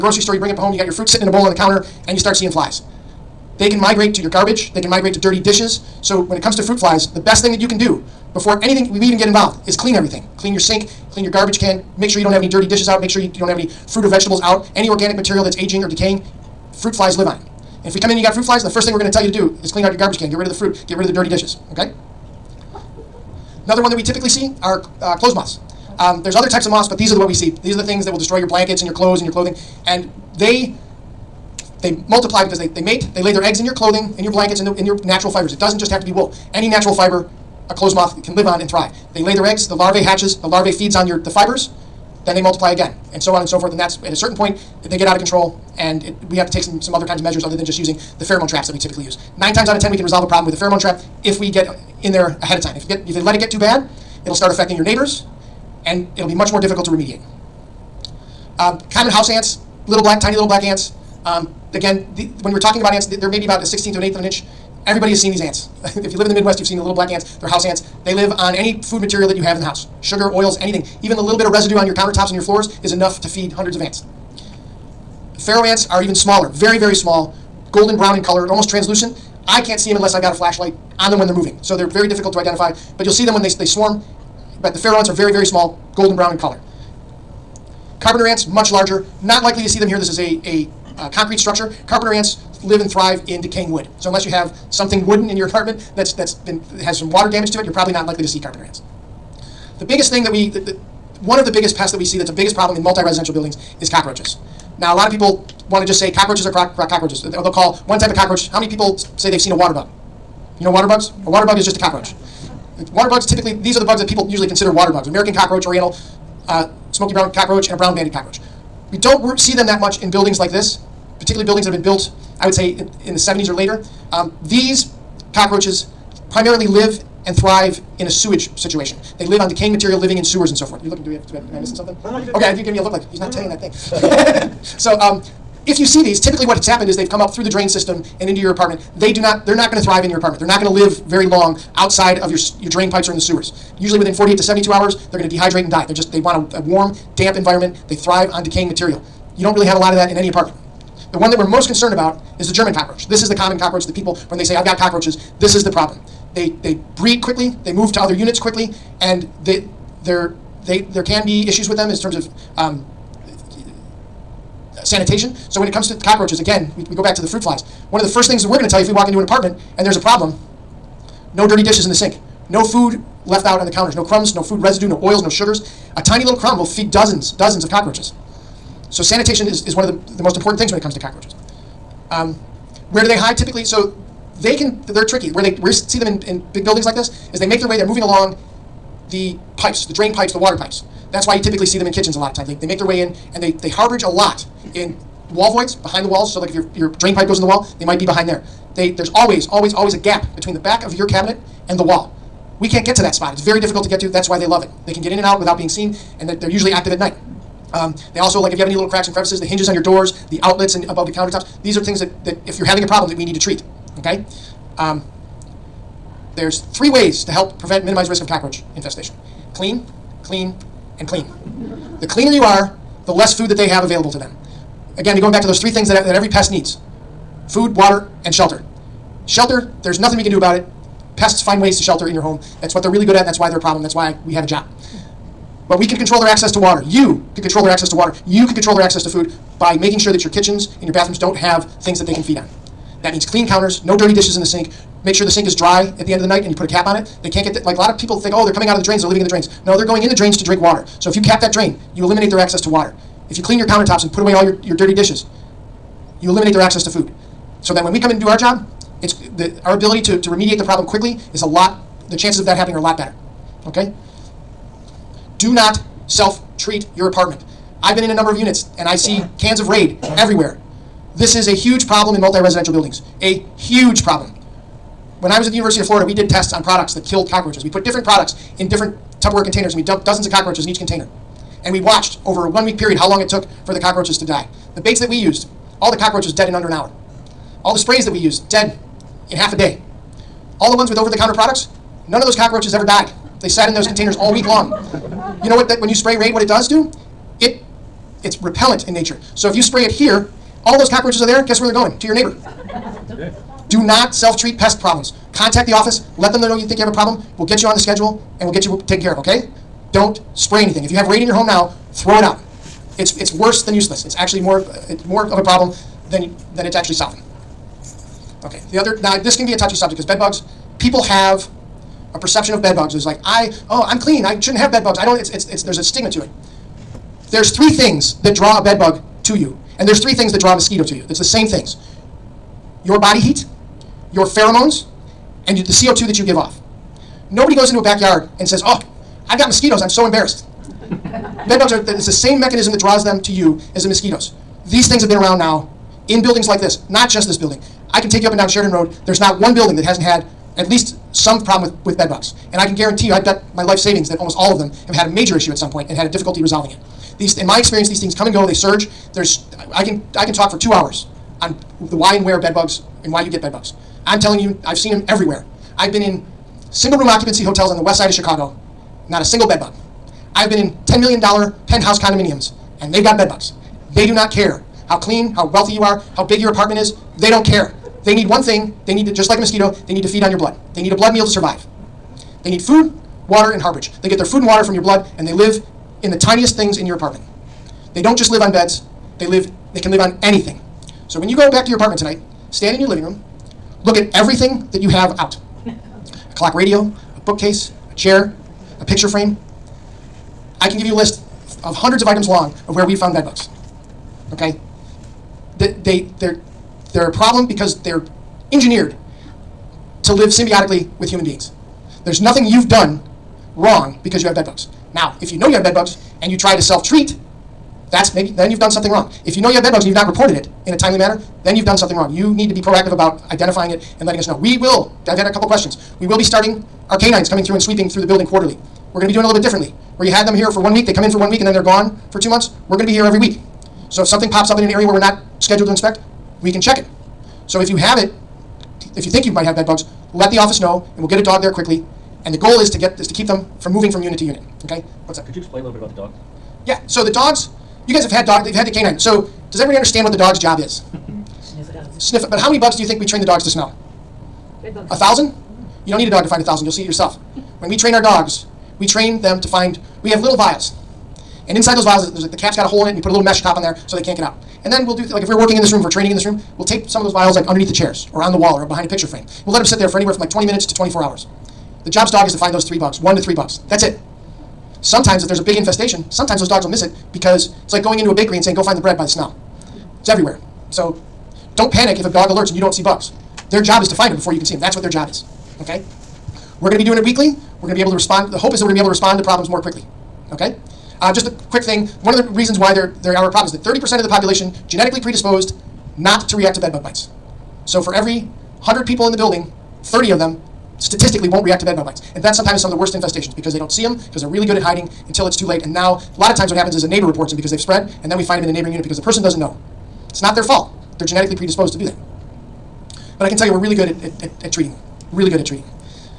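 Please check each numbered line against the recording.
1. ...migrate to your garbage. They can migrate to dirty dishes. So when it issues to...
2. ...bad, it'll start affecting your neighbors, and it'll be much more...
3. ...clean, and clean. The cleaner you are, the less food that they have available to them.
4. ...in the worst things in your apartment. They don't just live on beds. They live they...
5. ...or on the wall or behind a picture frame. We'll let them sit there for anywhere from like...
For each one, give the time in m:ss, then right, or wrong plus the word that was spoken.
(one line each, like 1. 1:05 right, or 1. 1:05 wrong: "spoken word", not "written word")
1. 0:03 wrong: "comes", not "issues"
2. 0:53 right
3. 3:40 right
4. 6:26 wrong: "tiniest", not "worst"
5. 7:48 right.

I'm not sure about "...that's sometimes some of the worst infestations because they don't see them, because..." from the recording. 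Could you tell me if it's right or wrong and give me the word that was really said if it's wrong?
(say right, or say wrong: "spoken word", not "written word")
right.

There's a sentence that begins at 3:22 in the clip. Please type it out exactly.
We can't get to that spot.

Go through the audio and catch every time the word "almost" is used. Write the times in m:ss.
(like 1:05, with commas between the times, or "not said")
1:18, 5:54.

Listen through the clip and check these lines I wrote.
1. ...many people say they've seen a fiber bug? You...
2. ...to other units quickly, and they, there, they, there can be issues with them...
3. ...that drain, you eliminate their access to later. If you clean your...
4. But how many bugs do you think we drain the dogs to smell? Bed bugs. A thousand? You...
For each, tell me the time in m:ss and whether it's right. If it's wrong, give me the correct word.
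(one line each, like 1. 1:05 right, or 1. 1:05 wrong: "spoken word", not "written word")
1. 1:48 wrong: "water", not "fiber"
2. 2:37 right
3. 4:11 wrong: "water", not "later"
4. 7:32 wrong: "train", not "drain".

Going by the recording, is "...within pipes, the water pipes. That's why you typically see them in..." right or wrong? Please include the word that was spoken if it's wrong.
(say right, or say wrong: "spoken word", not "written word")
wrong: "drain", not "within".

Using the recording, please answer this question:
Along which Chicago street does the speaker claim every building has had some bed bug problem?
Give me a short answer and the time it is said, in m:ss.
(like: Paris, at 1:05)
Sheridan Road, at 5:48.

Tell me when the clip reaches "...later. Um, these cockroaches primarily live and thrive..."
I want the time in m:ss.
2:03.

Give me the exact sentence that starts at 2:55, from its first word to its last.
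A tiny little crumb will feed dozens, dozens of cockroaches.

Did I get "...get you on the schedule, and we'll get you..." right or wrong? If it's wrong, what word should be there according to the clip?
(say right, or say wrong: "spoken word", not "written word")
right.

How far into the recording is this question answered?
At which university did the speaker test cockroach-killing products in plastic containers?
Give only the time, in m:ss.
4:35.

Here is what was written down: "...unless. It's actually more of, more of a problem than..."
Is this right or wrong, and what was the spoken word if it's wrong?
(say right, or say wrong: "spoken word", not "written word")
wrong: "useless", not "unless".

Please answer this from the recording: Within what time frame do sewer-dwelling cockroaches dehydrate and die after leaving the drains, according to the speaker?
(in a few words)
48 to 72 hours.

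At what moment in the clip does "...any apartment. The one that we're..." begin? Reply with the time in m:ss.
2:30.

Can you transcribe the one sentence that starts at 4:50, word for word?
All the ones with over the counter products, None of those cockroaches ever died.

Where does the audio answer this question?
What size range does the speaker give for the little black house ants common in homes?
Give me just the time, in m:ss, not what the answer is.
1:03.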